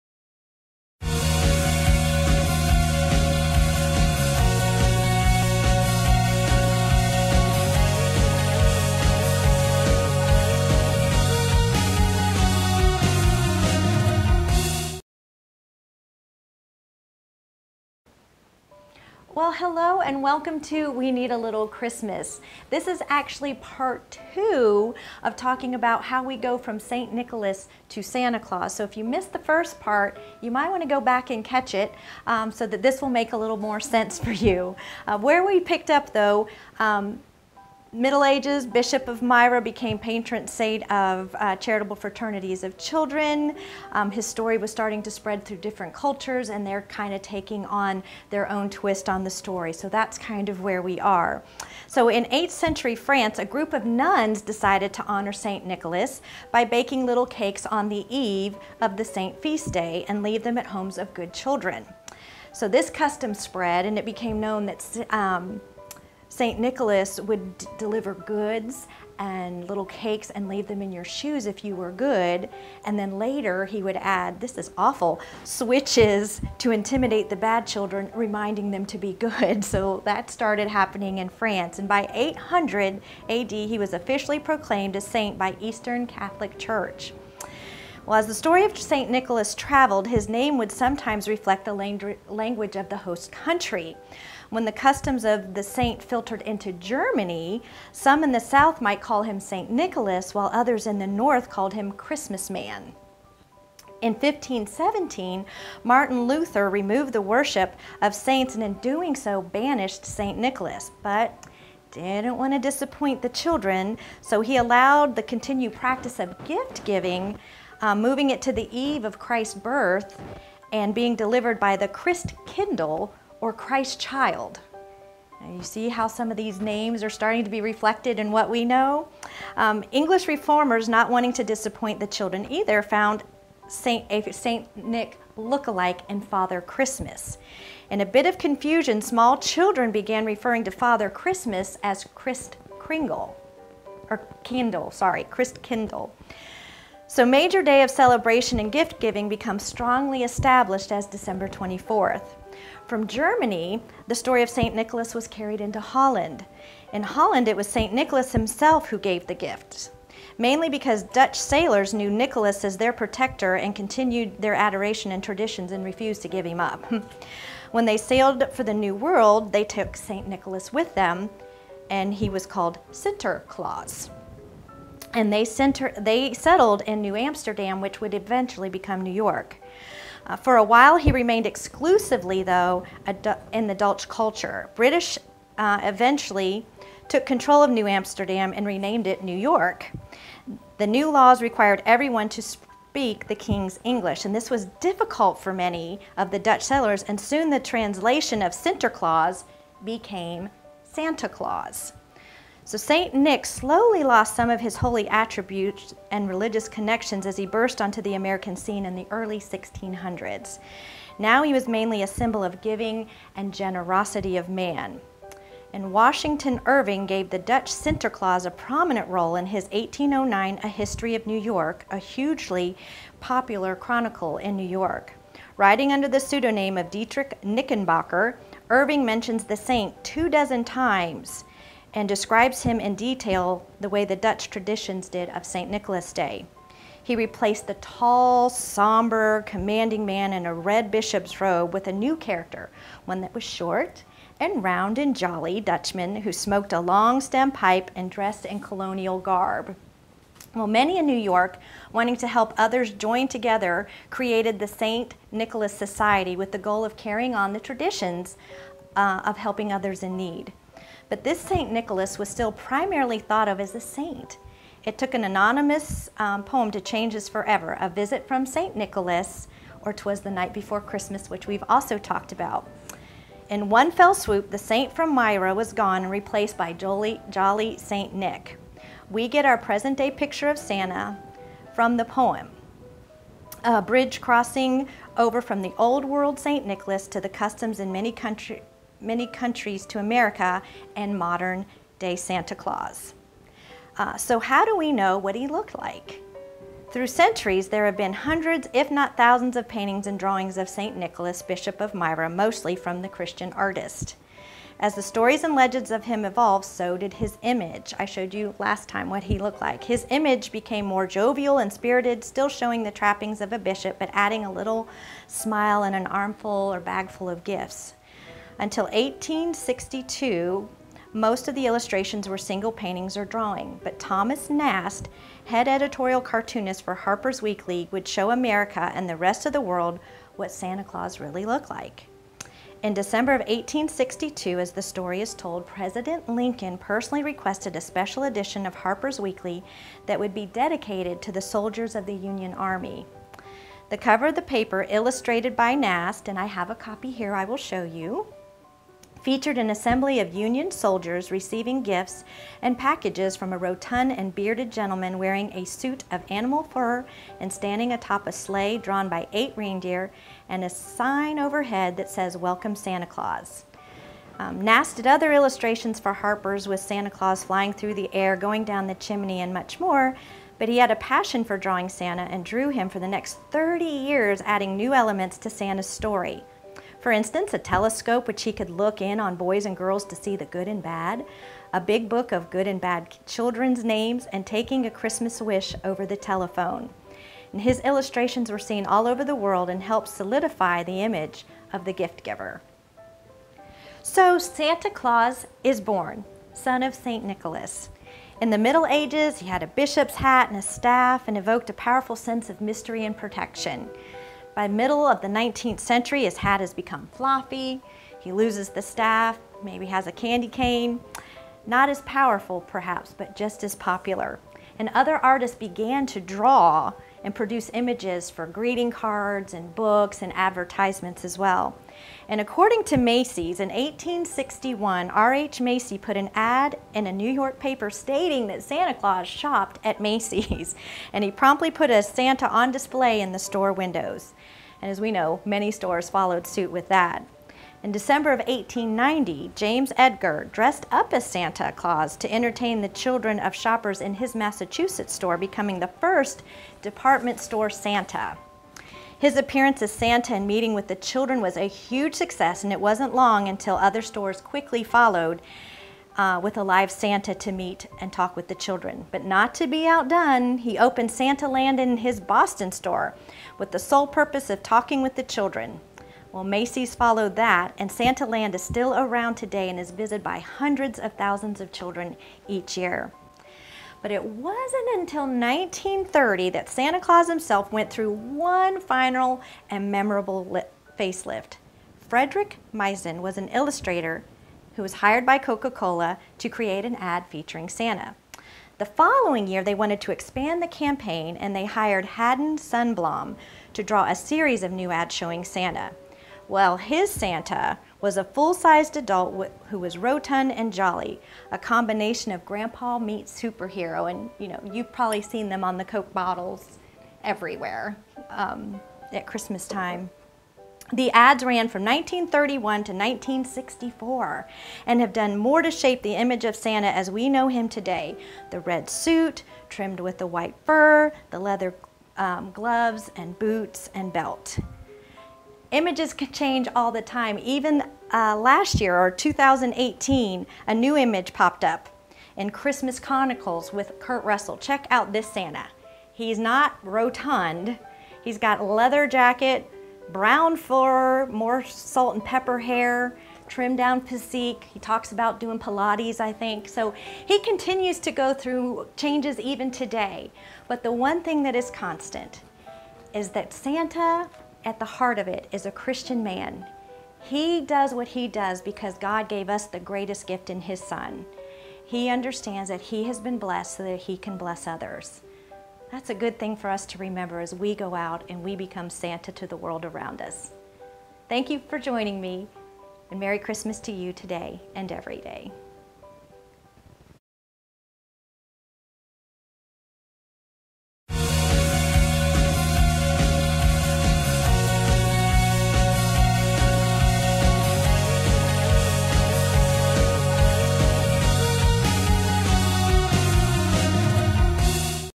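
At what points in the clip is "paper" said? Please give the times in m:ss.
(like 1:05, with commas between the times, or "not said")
5:44, 7:07.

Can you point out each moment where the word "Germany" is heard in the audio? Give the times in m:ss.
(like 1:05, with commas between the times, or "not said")
1:36, 2:33.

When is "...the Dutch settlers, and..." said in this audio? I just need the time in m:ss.
3:16.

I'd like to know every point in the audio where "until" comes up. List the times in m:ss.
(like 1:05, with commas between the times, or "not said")
5:18, 7:33, 7:54.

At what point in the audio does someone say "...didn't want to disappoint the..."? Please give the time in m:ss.
1:51.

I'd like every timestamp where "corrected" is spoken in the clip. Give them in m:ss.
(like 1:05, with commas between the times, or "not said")
not said.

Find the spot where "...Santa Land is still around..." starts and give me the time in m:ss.
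7:47.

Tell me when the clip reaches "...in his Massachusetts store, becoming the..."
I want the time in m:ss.
7:24.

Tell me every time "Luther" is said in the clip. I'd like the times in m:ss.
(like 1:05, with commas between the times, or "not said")
1:46.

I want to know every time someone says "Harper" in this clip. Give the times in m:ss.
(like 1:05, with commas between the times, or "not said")
5:26, 5:38, 6:06.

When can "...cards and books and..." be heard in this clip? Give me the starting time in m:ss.
6:58.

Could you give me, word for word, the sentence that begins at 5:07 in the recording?
I showed you last time what he looked like.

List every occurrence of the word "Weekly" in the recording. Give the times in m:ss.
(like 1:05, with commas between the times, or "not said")
5:27, 5:39.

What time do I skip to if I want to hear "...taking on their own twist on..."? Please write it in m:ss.
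0:47.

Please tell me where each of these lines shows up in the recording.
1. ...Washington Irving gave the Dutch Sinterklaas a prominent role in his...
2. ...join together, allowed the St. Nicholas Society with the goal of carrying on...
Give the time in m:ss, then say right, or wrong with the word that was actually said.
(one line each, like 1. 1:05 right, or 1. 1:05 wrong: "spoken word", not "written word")
1. 3:35 right
2. 4:12 wrong: "created", not "allowed".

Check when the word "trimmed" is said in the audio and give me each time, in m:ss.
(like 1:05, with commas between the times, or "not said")
8:39, 9:03.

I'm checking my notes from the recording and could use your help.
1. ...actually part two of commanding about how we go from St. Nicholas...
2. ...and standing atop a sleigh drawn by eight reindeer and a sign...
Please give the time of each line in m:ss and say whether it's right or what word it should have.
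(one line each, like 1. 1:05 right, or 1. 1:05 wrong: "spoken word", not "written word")
1. 0:23 wrong: "talking", not "commanding"
2. 5:57 right.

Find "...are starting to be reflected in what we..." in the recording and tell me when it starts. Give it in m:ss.
2:07.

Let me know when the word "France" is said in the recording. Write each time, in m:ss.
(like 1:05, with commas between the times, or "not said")
0:52, 1:21.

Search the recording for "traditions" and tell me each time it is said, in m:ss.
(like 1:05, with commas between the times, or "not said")
2:45, 3:54, 4:17.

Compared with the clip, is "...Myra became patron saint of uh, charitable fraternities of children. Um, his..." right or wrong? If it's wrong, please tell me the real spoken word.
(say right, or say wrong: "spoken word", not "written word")
right.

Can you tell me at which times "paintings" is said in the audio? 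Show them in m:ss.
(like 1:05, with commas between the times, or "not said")
4:59, 5:22.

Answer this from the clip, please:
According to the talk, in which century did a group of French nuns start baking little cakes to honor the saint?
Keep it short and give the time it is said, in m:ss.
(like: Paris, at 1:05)
8th century, at 0:52.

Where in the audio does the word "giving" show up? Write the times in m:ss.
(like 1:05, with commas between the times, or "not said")
1:56, 2:29, 3:32.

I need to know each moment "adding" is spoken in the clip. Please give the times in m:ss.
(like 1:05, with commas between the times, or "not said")
5:14, 6:14.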